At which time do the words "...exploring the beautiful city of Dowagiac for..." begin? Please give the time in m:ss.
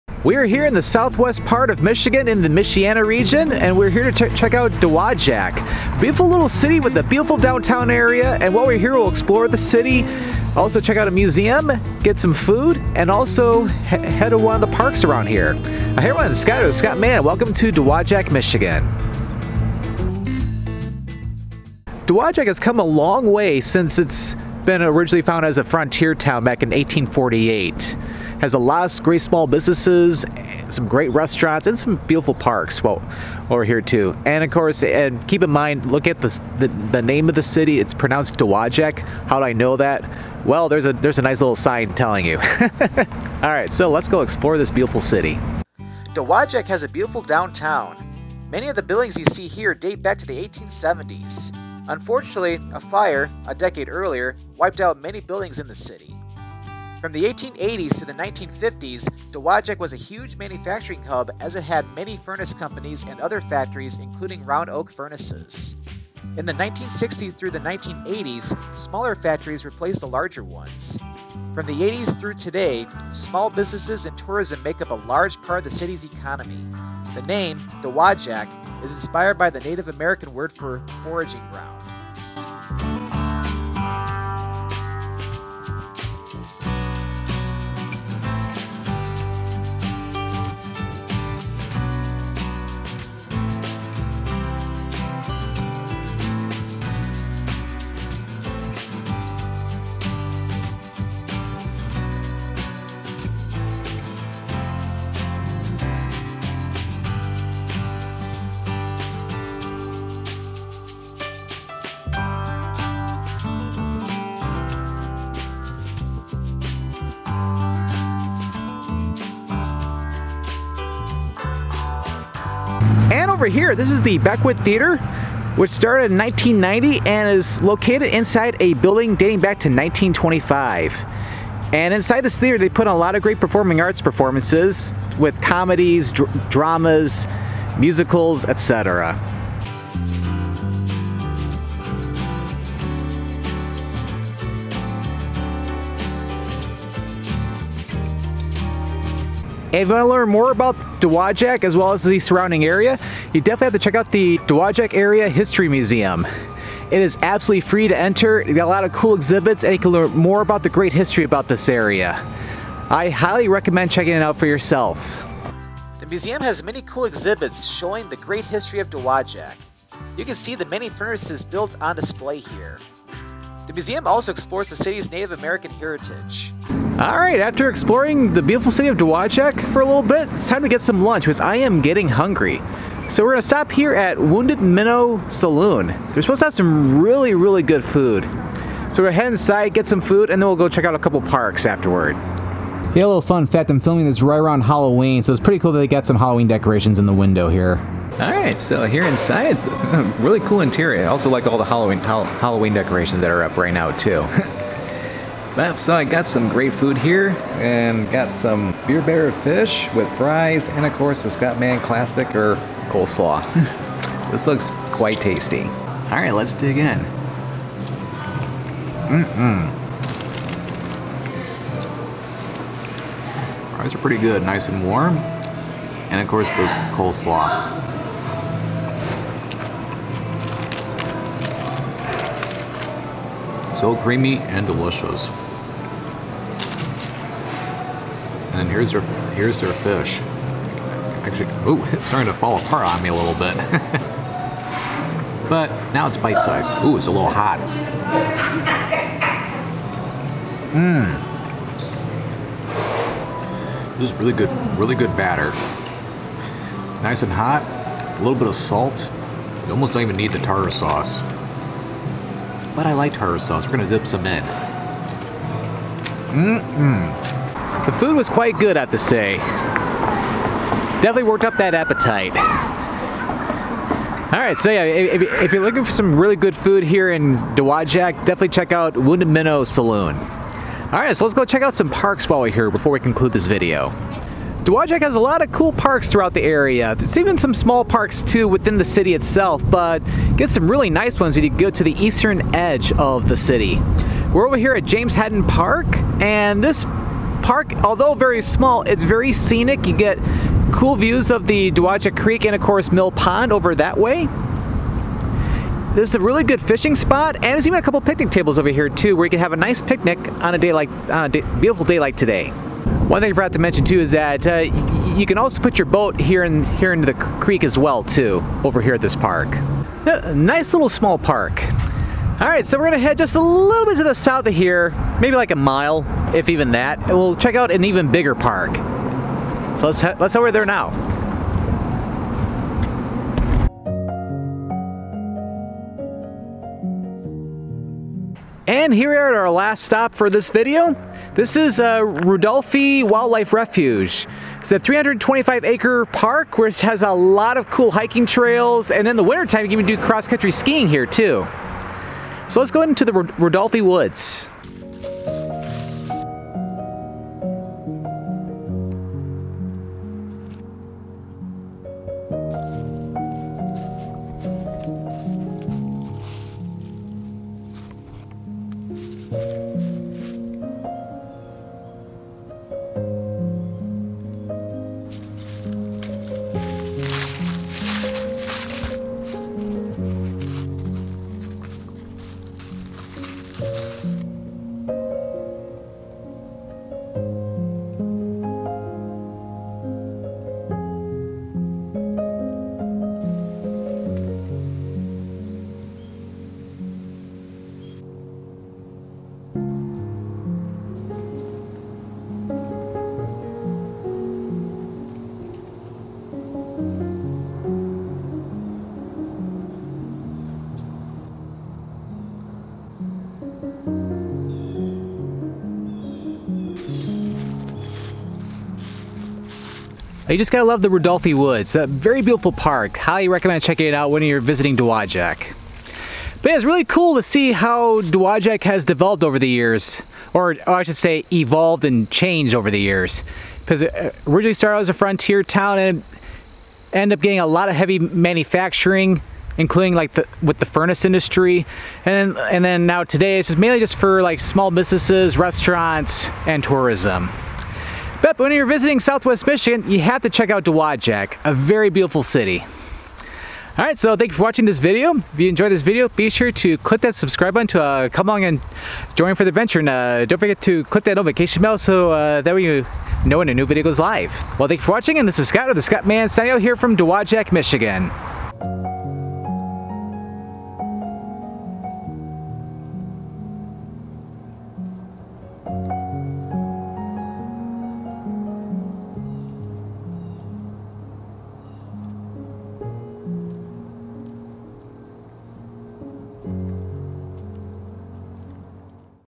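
2:57.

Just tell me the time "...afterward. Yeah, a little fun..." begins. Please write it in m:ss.
3:11.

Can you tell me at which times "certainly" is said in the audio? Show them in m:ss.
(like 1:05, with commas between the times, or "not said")
not said.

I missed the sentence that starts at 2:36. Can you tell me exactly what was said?
It is absolutely free to enter.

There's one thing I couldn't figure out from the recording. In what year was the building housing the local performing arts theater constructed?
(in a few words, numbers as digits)
1925.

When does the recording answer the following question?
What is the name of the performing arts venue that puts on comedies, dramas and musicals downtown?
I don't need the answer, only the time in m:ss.
2:04.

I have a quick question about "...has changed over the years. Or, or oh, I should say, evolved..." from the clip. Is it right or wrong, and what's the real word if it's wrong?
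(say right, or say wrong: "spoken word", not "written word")
wrong: "developed", not "changed".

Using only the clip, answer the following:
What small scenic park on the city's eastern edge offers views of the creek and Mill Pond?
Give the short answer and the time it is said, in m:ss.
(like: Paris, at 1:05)
James Haddon Park, at 4:54.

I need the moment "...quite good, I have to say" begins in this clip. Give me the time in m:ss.
4:28.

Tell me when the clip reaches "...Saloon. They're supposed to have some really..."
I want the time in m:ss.
3:05.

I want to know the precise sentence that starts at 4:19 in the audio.
You almost don't even need the tartar sauce but I like tartar sauce.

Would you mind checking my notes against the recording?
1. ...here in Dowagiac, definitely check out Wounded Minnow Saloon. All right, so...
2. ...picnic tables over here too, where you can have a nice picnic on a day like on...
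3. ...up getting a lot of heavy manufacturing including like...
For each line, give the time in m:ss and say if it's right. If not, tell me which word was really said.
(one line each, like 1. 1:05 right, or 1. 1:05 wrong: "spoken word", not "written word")
1. 4:36 right
2. 5:07 right
3. 7:17 right.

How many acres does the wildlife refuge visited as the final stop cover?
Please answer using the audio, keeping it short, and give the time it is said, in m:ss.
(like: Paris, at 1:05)
325, at 5:44.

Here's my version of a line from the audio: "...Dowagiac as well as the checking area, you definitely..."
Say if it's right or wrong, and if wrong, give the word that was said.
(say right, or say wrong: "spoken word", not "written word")
wrong: "surrounding", not "checking".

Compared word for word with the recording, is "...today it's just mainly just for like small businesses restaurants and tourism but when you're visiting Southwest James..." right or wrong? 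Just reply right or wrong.
wrong.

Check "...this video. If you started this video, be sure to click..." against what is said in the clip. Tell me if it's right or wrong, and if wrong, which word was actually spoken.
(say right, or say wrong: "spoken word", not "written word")
wrong: "enjoyed", not "started".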